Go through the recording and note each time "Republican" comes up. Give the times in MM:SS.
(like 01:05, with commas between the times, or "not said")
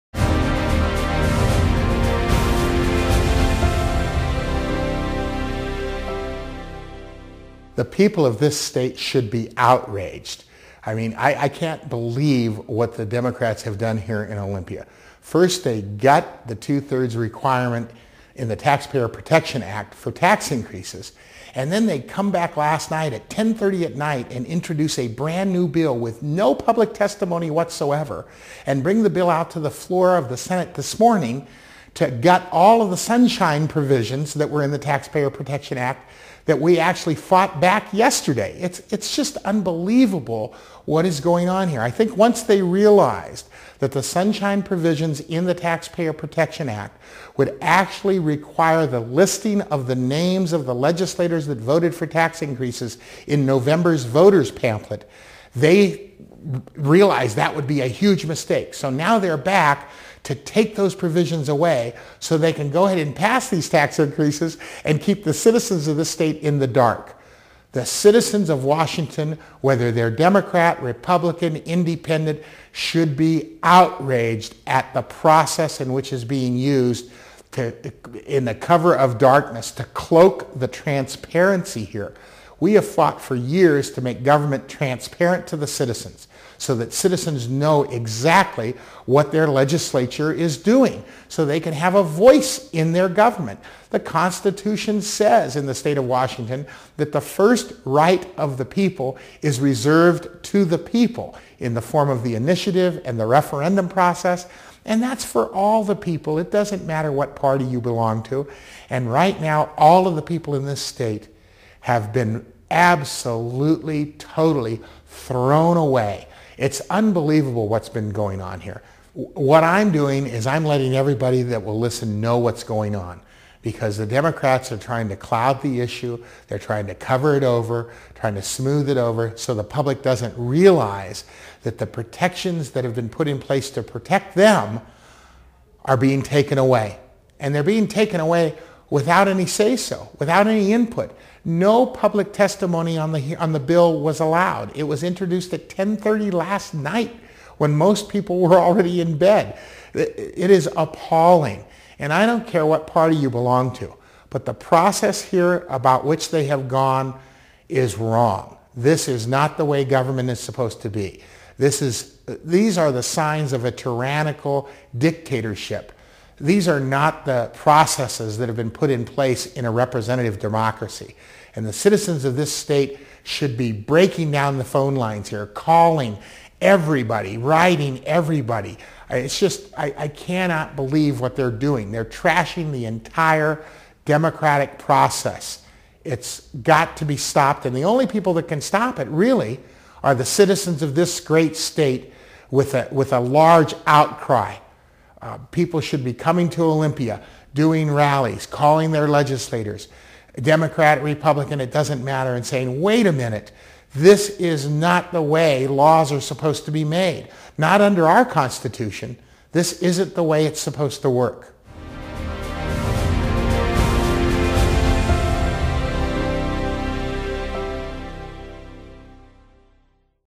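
01:10, 03:21.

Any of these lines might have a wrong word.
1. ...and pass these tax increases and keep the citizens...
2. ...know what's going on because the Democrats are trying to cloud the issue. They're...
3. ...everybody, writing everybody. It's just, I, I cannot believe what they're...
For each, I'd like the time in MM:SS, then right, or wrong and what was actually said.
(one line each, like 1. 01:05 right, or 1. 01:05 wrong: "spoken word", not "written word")
1. 01:02 right
2. 02:02 right
3. 02:56 right.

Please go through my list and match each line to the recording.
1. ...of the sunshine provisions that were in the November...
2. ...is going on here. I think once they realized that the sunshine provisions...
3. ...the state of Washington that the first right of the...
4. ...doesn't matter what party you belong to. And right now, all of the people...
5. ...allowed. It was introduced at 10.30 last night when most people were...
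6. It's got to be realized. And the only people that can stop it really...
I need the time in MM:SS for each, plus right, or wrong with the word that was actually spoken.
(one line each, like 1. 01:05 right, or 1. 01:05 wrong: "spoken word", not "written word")
1. 00:32 wrong: "Taxpayer", not "November"
2. 00:41 right
3. 01:35 right
4. 01:46 right
5. 02:24 right
6. 03:06 wrong: "stopped", not "realized".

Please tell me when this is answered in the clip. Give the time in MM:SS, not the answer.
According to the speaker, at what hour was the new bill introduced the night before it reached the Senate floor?
00:23.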